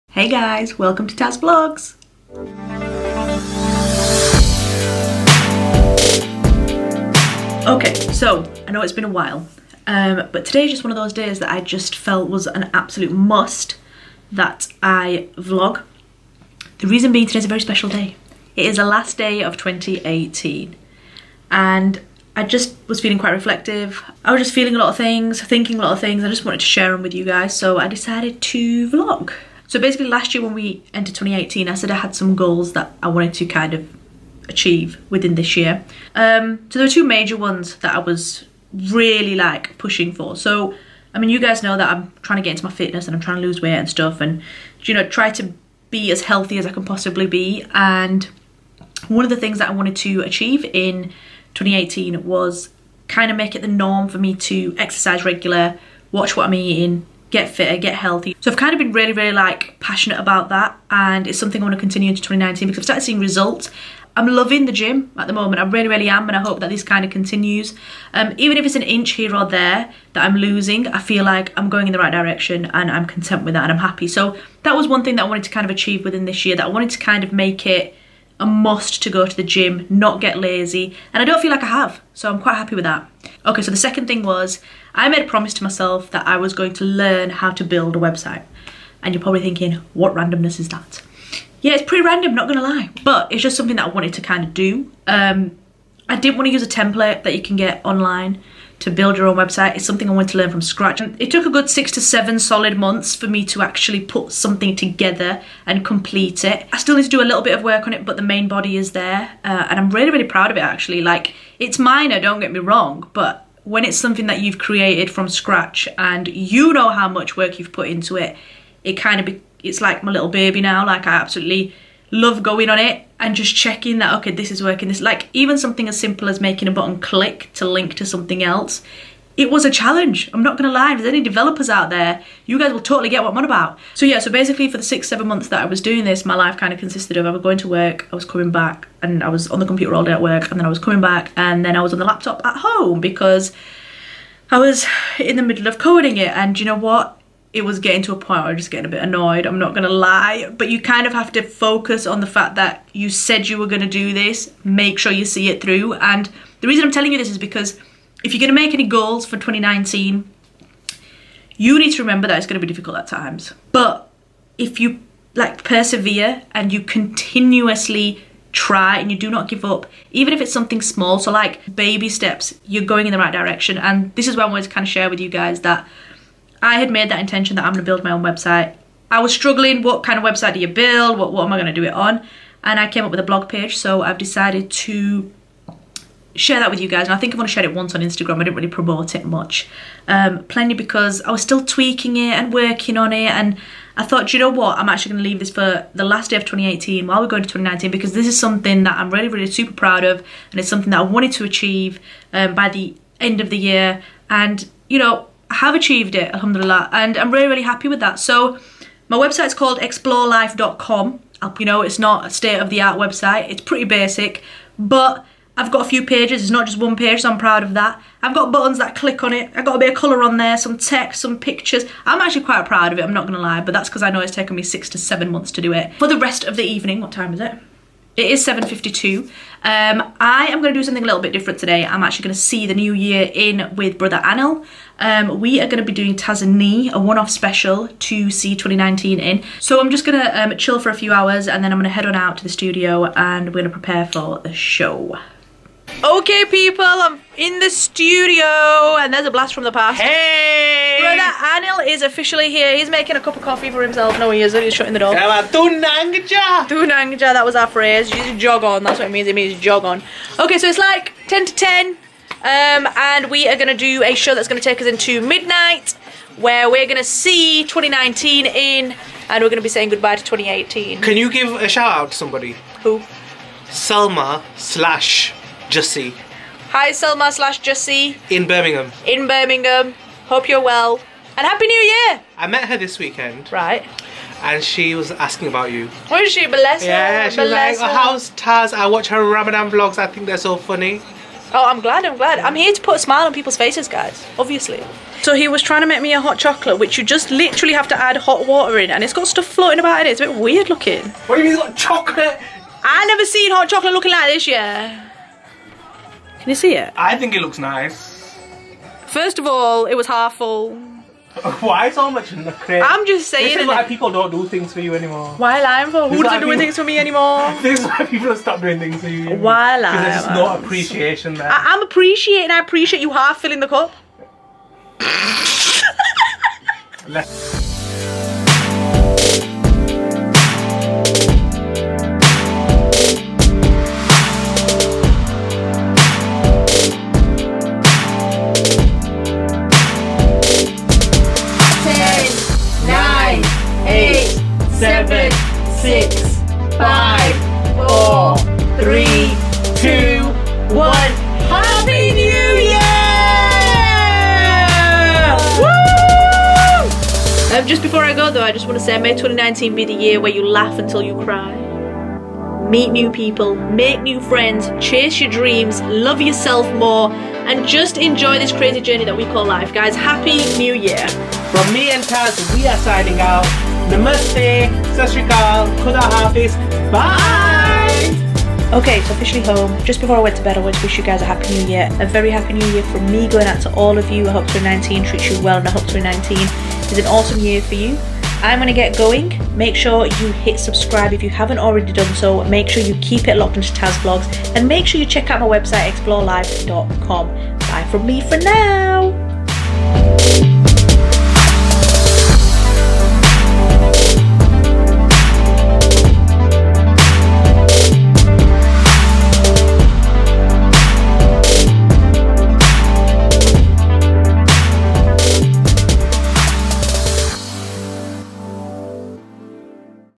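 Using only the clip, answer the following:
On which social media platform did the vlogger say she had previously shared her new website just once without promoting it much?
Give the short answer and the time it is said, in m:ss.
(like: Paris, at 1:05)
Instagram, at 3:08.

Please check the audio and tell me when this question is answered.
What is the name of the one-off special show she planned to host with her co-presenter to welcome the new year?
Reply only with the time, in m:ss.
3:56.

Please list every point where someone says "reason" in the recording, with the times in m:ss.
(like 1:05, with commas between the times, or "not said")
0:16, 2:36.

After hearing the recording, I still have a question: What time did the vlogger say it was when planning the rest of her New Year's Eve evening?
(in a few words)
7:52.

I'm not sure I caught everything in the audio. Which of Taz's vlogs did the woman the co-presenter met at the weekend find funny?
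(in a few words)
Ramadan vlogs.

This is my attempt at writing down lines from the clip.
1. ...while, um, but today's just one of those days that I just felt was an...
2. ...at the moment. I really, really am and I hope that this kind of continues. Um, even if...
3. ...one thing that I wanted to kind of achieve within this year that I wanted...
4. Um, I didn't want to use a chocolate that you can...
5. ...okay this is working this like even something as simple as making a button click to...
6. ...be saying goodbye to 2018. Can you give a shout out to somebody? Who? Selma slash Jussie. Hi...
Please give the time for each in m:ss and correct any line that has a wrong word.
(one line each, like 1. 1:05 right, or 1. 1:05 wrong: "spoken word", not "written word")
1. 0:09 right
2. 1:05 right
3. 1:14 right
4. 1:35 wrong: "template", not "chocolate"
5. 2:04 right
6. 4:29 right.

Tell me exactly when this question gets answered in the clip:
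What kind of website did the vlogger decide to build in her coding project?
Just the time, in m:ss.
3:03.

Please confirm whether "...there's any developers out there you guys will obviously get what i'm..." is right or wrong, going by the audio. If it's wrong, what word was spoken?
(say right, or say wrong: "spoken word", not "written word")
wrong: "totally", not "obviously".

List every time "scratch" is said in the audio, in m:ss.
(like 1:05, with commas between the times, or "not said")
1:40, 1:55.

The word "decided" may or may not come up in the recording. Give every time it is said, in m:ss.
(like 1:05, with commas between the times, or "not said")
0:27, 3:04.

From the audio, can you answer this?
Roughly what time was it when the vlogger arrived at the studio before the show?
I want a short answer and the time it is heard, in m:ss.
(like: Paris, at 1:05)
10 to 10, at 4:21.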